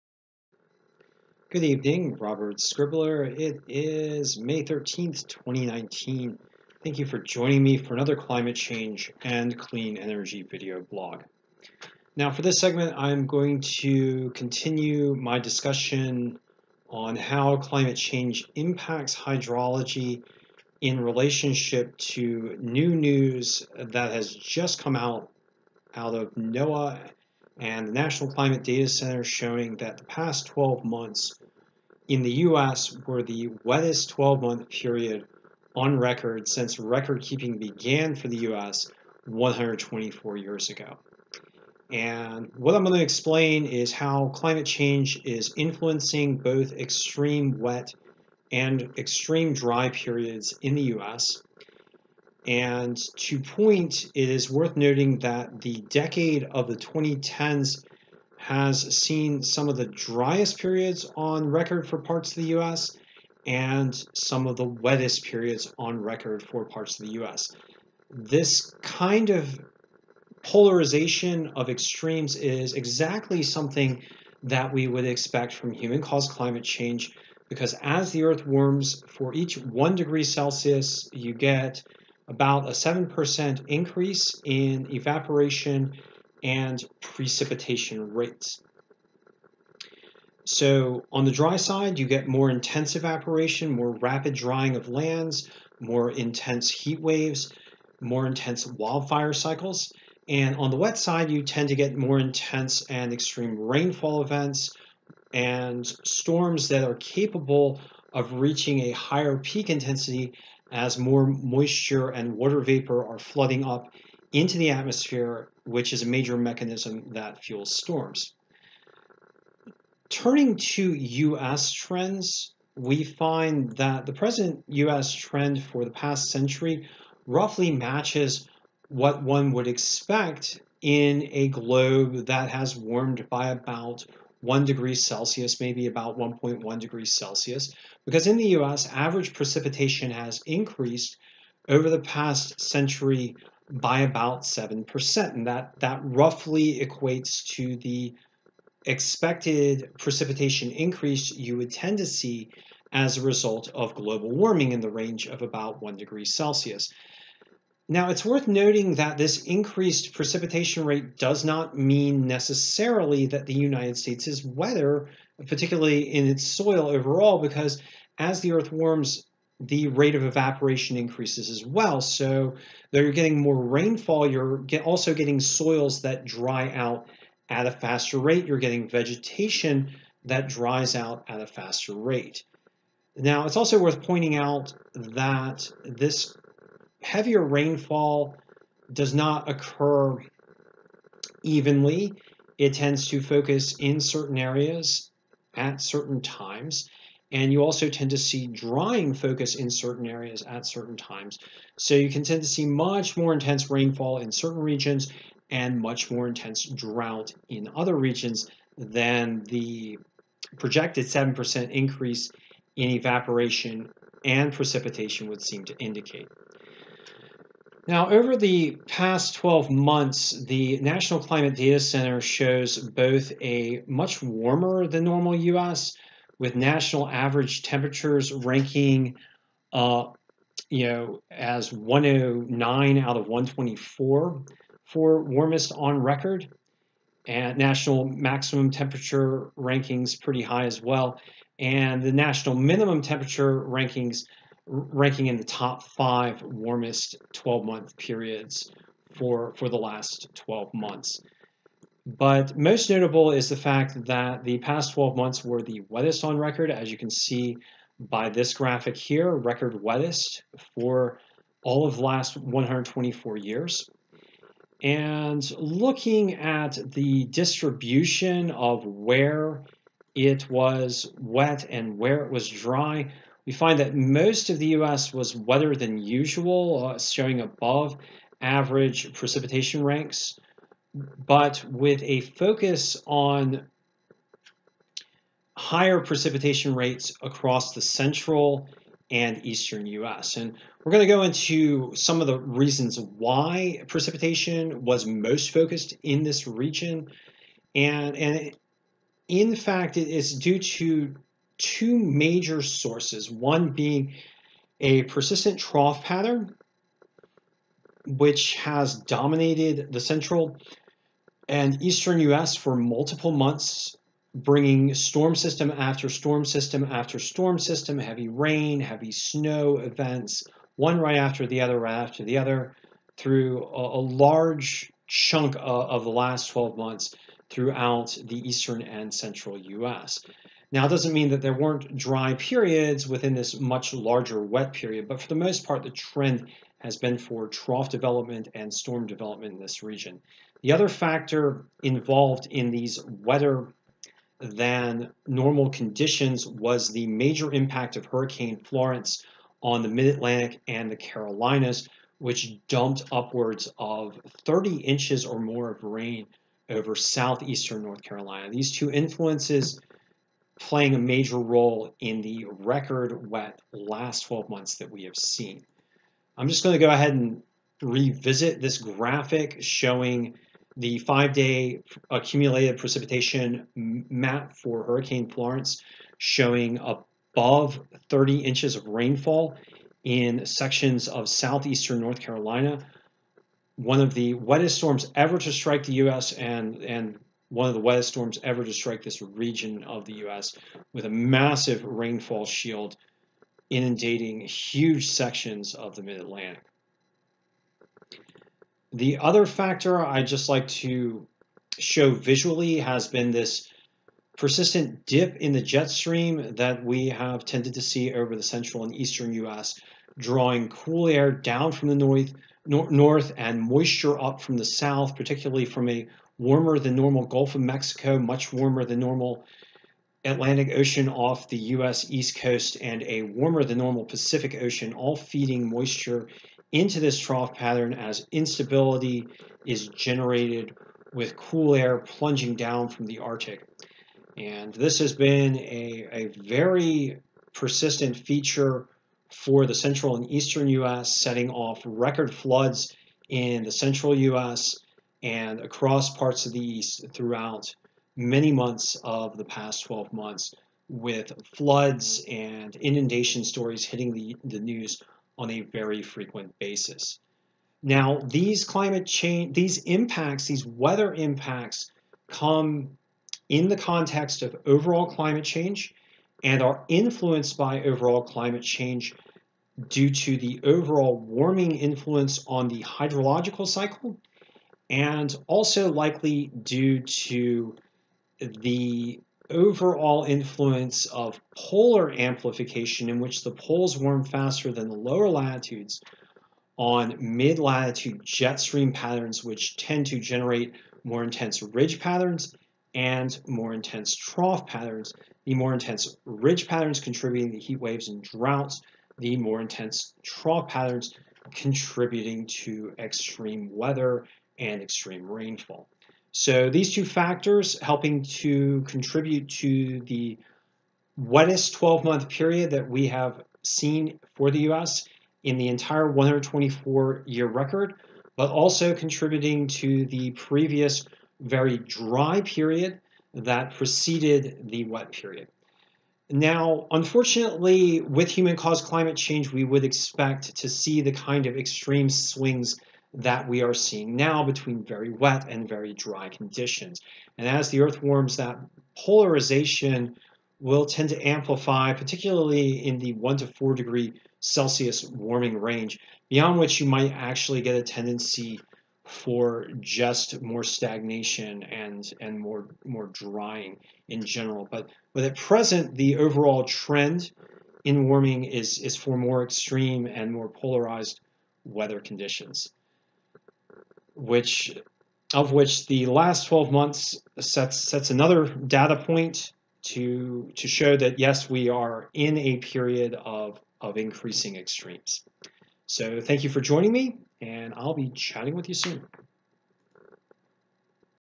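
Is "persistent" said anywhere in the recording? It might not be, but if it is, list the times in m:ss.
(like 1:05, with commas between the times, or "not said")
5:05, 6:44, 7:17.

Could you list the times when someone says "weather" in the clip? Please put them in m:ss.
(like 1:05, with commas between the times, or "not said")
7:40, 8:23, 9:21.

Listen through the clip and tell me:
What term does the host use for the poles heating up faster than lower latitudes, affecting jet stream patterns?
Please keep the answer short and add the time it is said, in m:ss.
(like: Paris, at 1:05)
polar amplification, at 8:01.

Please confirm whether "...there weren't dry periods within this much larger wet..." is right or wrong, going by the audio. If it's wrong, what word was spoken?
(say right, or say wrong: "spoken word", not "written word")
right.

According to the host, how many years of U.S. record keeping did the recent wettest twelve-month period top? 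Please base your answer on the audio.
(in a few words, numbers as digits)
124 years.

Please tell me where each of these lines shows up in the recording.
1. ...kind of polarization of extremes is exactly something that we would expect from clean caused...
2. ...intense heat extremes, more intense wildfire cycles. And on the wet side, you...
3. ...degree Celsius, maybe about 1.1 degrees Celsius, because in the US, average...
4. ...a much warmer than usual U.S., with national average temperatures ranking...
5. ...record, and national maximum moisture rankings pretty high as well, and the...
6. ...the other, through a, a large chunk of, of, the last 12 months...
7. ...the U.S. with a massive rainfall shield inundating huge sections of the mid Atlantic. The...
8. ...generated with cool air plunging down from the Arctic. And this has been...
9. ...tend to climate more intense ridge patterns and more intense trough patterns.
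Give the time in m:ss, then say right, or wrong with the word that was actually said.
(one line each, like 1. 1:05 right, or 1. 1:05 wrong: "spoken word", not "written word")
1. 1:08 wrong: "human", not "clean"
2. 1:36 wrong: "waves", not "extremes"
3. 2:14 right
4. 3:43 wrong: "normal", not "usual"
5. 3:55 wrong: "temperature", not "moisture"
6. 5:22 right
7. 6:30 right
8. 7:09 right
9. 8:09 wrong: "generate", not "climate".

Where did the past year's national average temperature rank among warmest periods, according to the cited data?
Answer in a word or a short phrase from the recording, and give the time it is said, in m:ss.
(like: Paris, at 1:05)
109, at 3:51.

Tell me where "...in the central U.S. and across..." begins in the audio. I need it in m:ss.
7:23.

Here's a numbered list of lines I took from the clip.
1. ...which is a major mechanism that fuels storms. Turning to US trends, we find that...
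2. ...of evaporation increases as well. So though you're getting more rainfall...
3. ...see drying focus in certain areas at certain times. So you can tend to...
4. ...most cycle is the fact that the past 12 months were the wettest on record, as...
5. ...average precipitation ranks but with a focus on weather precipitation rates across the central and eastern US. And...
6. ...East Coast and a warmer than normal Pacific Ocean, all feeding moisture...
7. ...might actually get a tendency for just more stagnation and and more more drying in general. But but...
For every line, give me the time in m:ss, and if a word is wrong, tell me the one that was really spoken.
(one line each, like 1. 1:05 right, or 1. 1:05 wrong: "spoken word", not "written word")
1. 1:55 right
2. 2:50 right
3. 3:18 right
4. 4:12 wrong: "notable", not "cycle"
5. 4:38 wrong: "higher", not "weather"
6. 7:02 right
7. 9:06 right.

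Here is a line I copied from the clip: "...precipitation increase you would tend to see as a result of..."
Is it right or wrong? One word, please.
right.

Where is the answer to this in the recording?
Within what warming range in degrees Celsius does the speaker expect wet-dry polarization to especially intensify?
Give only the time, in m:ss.
9:03.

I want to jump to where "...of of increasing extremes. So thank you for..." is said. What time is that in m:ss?
9:33.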